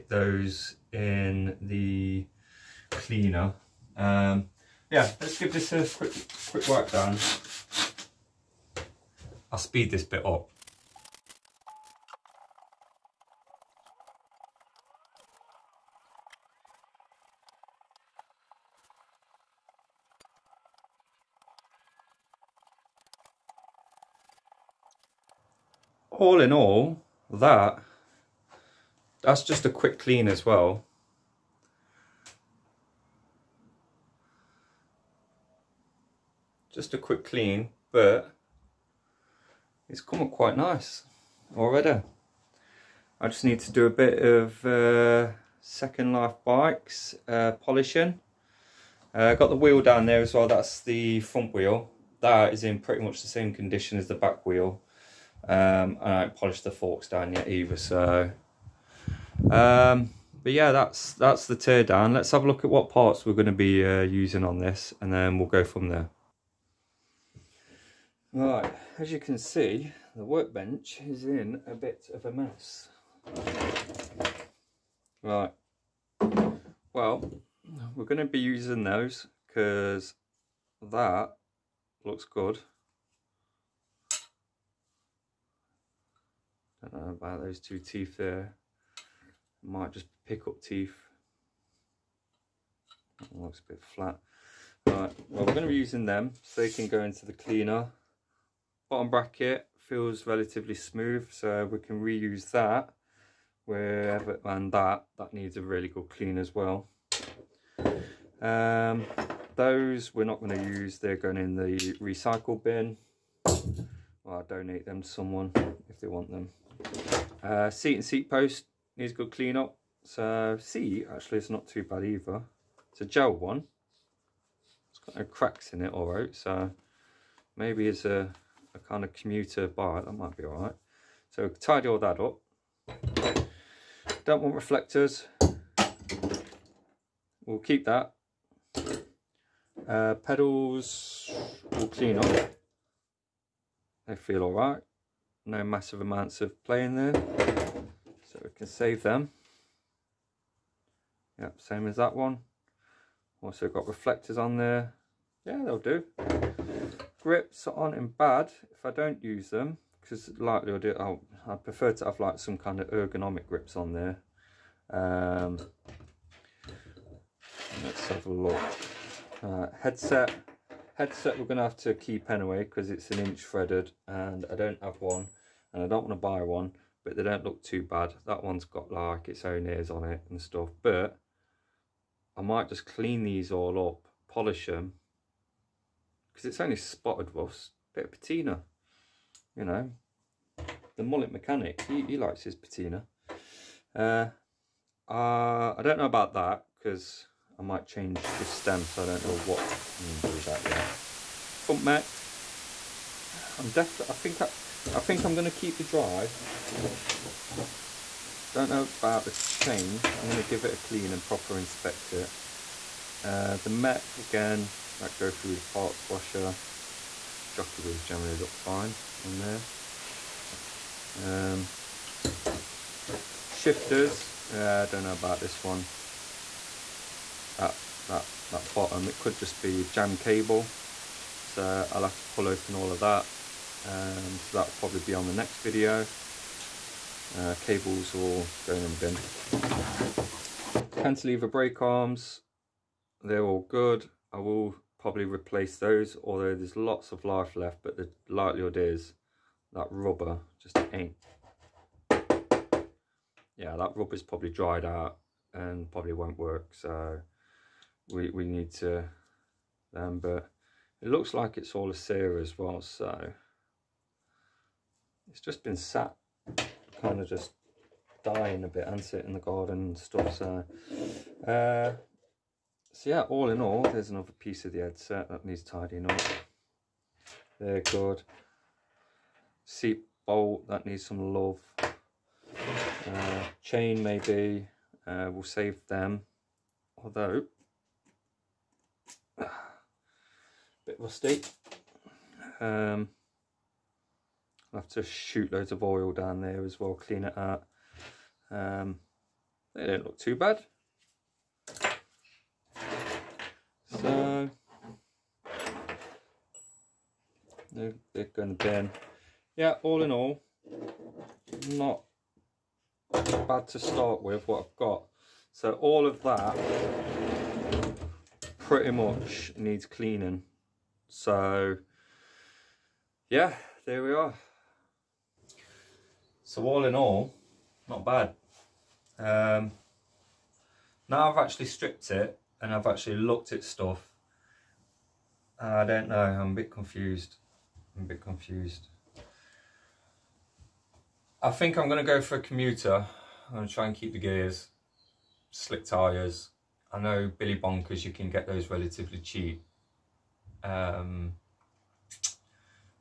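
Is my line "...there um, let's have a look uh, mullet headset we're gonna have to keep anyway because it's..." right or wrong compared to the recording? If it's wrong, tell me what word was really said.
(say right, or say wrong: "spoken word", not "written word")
wrong: "headset", not "mullet".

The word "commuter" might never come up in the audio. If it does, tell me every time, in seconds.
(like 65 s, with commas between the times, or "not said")
129 s, 342 s.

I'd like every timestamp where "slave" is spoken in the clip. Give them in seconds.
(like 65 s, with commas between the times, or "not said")
not said.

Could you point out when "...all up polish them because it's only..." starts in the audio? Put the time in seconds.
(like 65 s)
183 s.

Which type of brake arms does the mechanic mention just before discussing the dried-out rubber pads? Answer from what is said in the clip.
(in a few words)
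Cantilever.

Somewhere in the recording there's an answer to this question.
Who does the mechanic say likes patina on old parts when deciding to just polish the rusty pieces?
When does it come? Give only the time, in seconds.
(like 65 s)
190 s.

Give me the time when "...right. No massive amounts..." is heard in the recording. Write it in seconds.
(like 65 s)
144 s.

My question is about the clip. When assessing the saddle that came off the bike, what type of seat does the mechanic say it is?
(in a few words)
Gel.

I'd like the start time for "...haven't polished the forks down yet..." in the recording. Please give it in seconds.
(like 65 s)
56 s.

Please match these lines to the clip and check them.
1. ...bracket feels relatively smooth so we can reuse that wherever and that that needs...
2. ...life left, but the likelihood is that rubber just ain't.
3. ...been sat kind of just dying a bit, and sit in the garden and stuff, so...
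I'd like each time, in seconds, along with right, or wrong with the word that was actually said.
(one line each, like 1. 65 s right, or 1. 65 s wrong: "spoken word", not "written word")
1. 99 s right
2. 247 s right
3. 265 s right.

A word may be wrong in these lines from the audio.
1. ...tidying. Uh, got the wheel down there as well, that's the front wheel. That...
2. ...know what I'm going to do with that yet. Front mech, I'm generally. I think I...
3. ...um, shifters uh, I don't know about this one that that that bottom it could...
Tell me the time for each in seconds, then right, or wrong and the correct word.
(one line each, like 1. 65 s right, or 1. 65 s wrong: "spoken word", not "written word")
1. 47 s wrong: "polishing", not "tidying"
2. 199 s wrong: "definitely", not "generally"
3. 221 s right.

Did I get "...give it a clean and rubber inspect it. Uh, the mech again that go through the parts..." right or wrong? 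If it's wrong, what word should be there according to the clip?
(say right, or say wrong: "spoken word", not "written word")
wrong: "proper", not "rubber".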